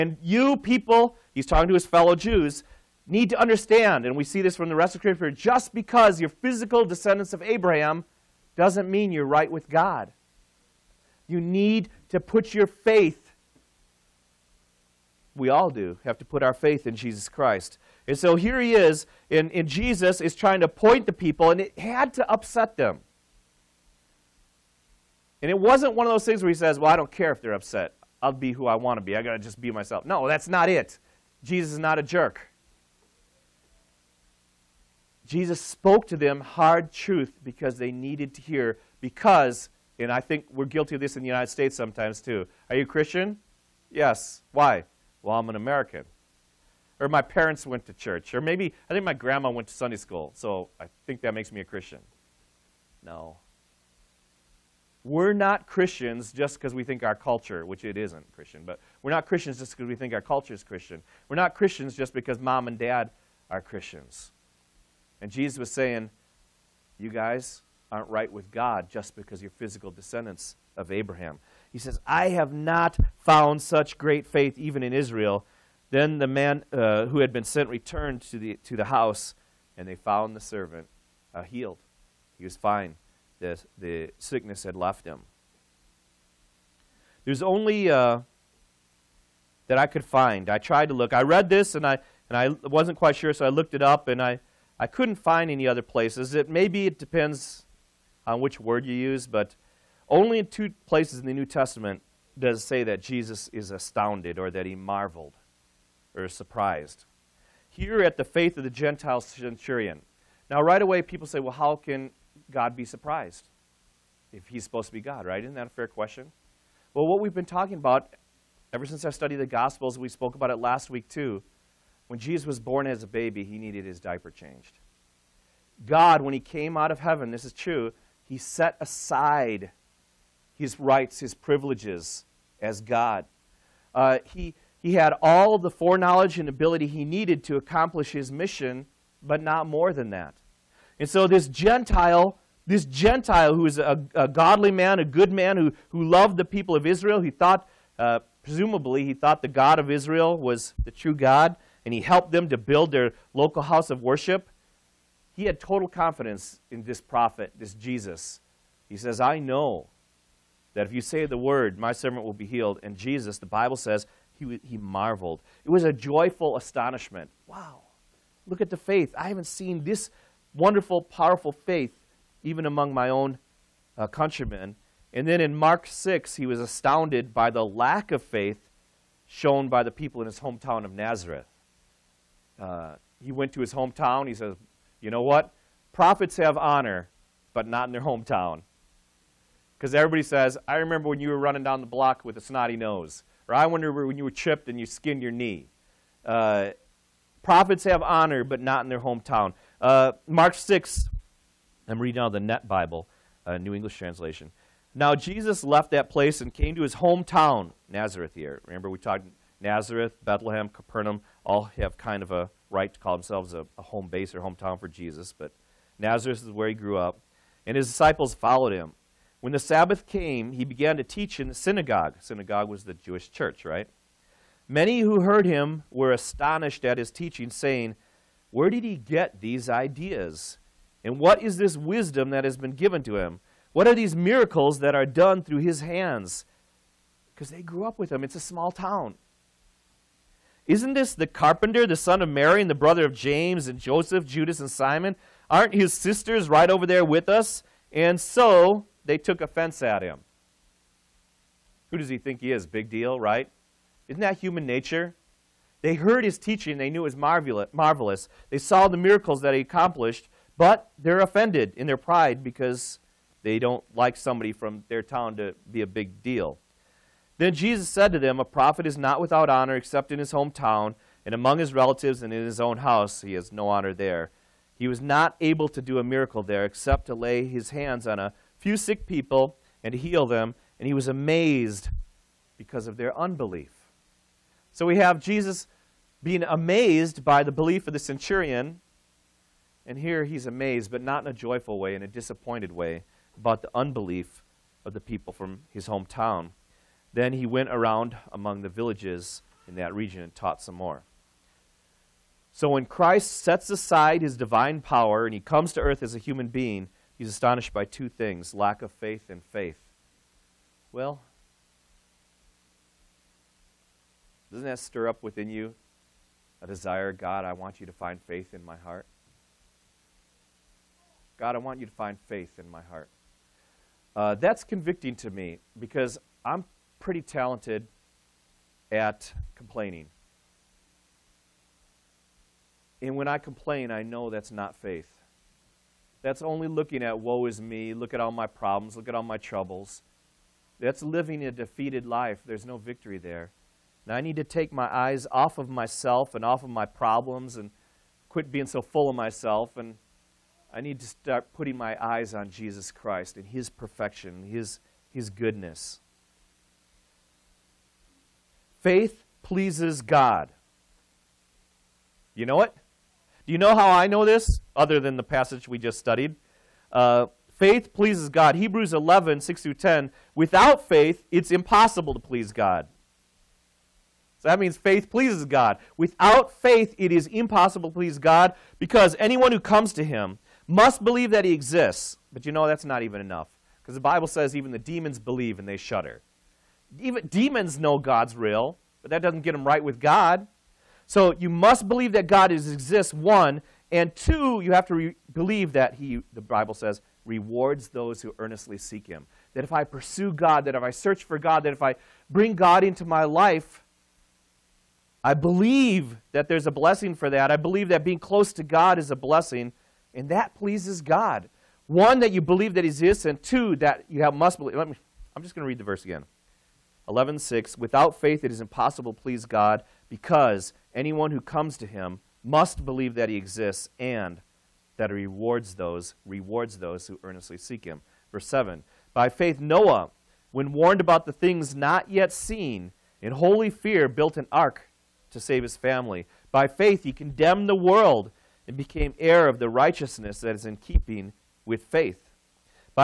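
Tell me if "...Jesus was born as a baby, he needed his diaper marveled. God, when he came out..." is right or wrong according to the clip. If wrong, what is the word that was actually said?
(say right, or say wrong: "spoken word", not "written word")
wrong: "changed", not "marveled".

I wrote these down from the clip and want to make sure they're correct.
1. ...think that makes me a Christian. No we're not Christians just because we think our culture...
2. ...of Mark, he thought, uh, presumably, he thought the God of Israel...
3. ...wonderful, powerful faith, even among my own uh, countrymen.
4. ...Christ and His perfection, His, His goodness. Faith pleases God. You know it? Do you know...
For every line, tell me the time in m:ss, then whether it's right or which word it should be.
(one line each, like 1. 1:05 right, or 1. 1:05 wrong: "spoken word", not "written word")
1. 0:51 right
2. 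2:26 wrong: "Israel", not "Mark"
3. 2:50 right
4. 5:52 right.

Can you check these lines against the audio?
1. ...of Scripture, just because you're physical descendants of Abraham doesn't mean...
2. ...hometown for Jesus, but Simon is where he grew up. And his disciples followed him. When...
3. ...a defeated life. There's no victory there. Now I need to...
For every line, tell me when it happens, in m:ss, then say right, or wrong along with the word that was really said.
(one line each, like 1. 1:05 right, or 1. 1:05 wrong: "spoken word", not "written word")
1. 0:04 right
2. 3:34 wrong: "Nazareth", not "Simon"
3. 5:41 right.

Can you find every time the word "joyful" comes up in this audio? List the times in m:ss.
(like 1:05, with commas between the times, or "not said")
2:45, 4:51.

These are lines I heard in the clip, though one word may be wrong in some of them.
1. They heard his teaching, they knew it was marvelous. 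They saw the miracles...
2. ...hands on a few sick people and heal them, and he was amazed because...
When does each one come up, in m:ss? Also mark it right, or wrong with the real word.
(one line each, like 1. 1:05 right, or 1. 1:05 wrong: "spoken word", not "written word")
1. 4:15 right
2. 4:37 right.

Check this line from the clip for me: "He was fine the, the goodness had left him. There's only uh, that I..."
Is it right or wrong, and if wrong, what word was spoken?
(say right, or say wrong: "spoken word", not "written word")
wrong: "sickness", not "goodness".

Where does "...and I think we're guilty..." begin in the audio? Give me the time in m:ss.
0:39.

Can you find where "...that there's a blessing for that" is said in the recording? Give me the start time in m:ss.
6:46.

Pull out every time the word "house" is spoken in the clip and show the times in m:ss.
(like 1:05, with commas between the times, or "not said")
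1:18, 2:33, 4:32.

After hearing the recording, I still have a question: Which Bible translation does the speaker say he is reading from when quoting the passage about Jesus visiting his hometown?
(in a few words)
NET Bible.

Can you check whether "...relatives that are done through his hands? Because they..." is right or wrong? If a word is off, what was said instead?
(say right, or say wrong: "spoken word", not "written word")
wrong: "miracles", not "relatives".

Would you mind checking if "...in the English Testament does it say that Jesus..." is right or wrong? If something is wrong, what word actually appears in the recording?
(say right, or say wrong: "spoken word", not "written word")
wrong: "New", not "English".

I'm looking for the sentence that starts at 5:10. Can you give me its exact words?
Well, Doesn't that stir up within you a desire, God, I want you to find faith in my heart?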